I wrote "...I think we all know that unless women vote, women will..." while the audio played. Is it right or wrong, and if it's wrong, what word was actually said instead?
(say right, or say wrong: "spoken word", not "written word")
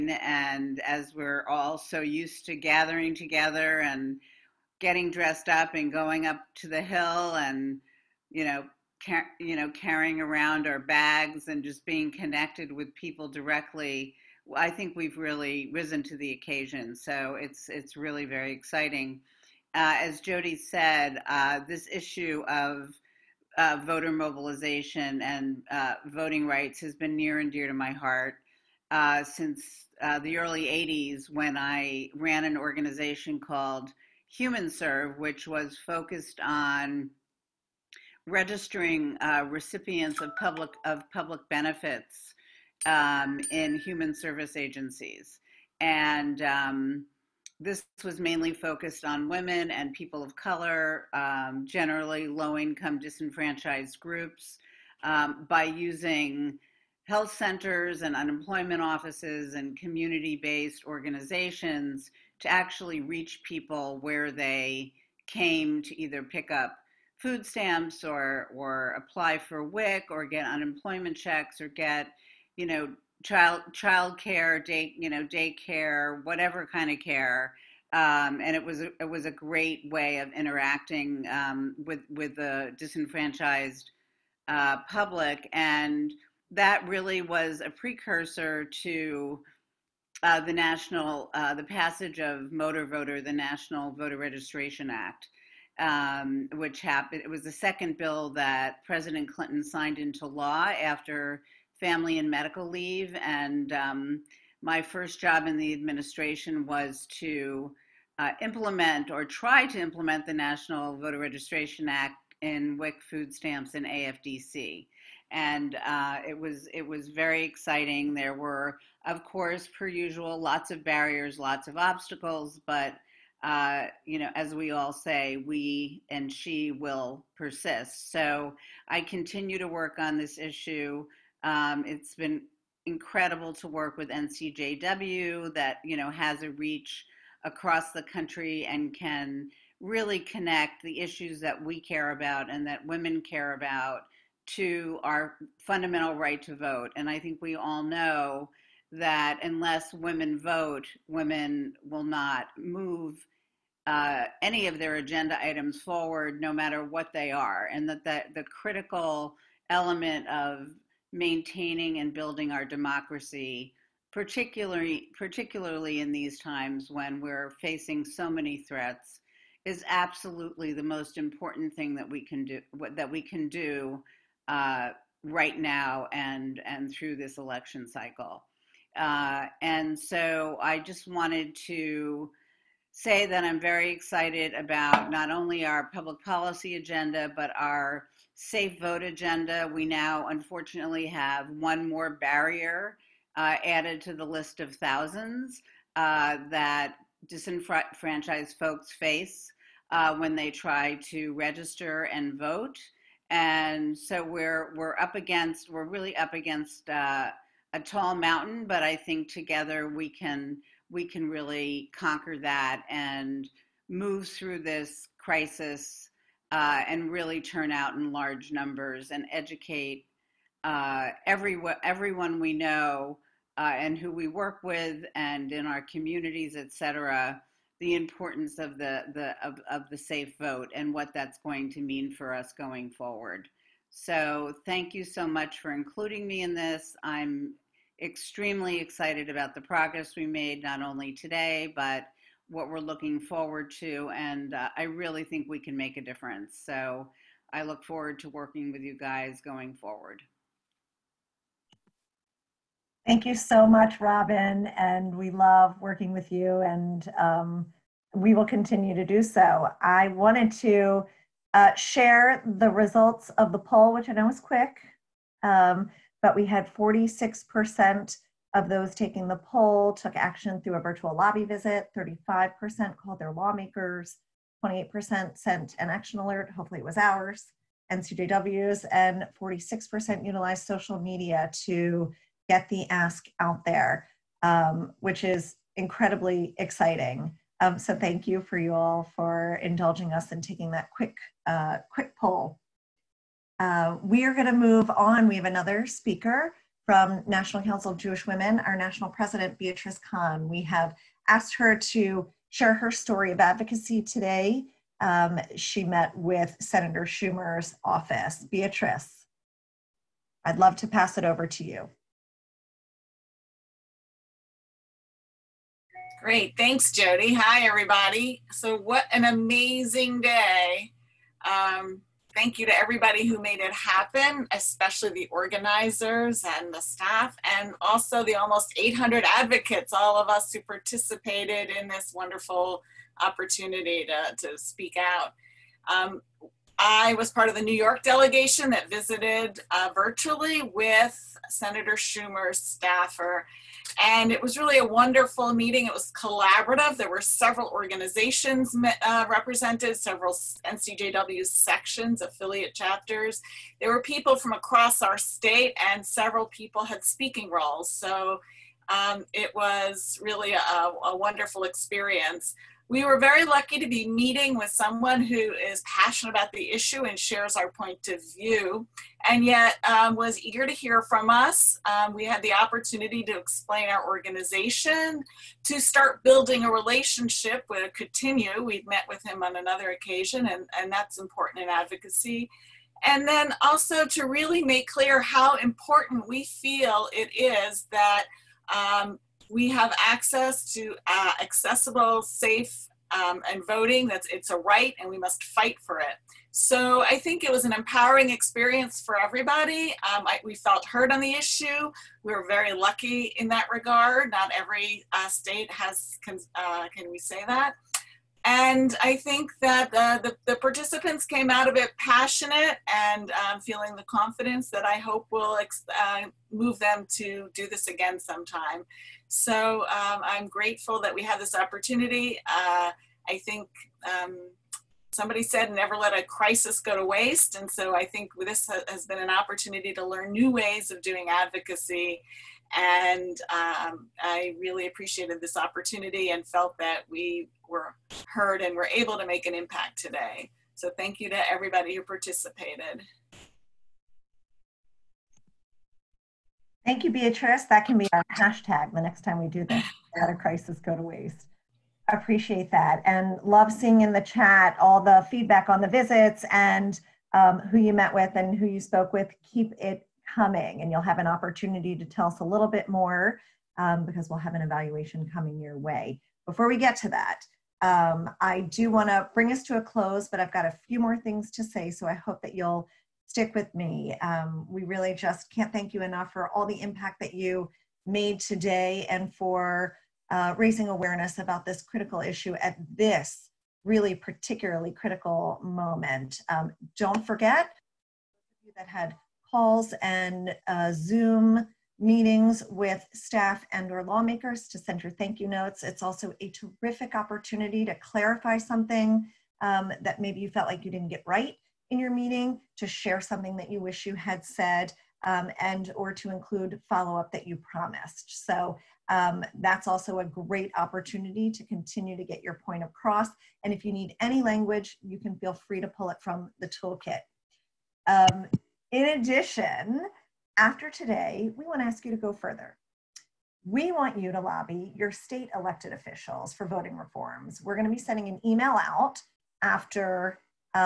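right.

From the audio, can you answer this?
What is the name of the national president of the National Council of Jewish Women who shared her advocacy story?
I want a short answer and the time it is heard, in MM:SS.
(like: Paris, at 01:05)
Beatrice Kahn, at 04:59.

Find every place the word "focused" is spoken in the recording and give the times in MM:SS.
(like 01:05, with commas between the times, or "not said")
00:35, 00:48.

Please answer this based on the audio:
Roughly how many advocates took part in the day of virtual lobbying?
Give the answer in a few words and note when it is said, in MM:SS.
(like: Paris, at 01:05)
800, at 05:28.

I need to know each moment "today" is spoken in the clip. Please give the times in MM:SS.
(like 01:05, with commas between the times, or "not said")
04:01, 05:04, 07:19, 07:58, 08:40.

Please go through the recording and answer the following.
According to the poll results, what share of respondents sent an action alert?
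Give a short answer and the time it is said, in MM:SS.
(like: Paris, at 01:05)
28%, at 04:34.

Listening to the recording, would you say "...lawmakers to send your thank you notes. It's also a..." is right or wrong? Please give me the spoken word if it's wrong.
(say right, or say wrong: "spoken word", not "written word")
right.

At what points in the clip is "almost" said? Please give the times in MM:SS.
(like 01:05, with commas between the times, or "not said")
05:28.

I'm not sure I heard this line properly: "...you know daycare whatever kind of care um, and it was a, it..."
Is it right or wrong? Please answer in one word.
right.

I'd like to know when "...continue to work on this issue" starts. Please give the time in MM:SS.
02:09.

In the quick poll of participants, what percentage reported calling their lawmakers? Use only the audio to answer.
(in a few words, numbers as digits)
35%.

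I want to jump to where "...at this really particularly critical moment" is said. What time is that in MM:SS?
08:02.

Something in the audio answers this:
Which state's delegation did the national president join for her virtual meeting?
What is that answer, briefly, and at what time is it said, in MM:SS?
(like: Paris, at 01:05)
New York, at 05:37.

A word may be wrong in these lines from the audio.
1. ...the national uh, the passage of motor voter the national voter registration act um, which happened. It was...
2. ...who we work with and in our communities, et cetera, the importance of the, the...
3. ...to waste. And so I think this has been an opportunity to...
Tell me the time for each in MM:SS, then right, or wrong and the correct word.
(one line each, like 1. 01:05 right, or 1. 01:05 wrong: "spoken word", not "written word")
1. 01:30 right
2. 03:43 right
3. 07:06 right.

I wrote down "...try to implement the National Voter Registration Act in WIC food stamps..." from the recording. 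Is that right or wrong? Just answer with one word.
right.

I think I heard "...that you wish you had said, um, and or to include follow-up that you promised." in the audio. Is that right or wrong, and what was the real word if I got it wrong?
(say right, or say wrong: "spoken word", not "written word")
right.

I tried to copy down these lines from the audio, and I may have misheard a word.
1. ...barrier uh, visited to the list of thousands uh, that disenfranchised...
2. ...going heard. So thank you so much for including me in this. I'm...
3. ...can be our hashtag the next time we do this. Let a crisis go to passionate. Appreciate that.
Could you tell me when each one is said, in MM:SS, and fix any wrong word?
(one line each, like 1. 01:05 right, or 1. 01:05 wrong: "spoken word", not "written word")
1. 03:12 wrong: "added", not "visited"
2. 03:52 wrong: "forward", not "heard"
3. 07:27 wrong: "waste", not "passionate".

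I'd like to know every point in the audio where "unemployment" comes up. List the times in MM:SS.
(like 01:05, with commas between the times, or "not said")
00:58, 01:10.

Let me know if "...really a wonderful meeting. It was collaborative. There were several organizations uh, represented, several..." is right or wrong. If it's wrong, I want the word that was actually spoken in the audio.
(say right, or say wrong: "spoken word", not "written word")
right.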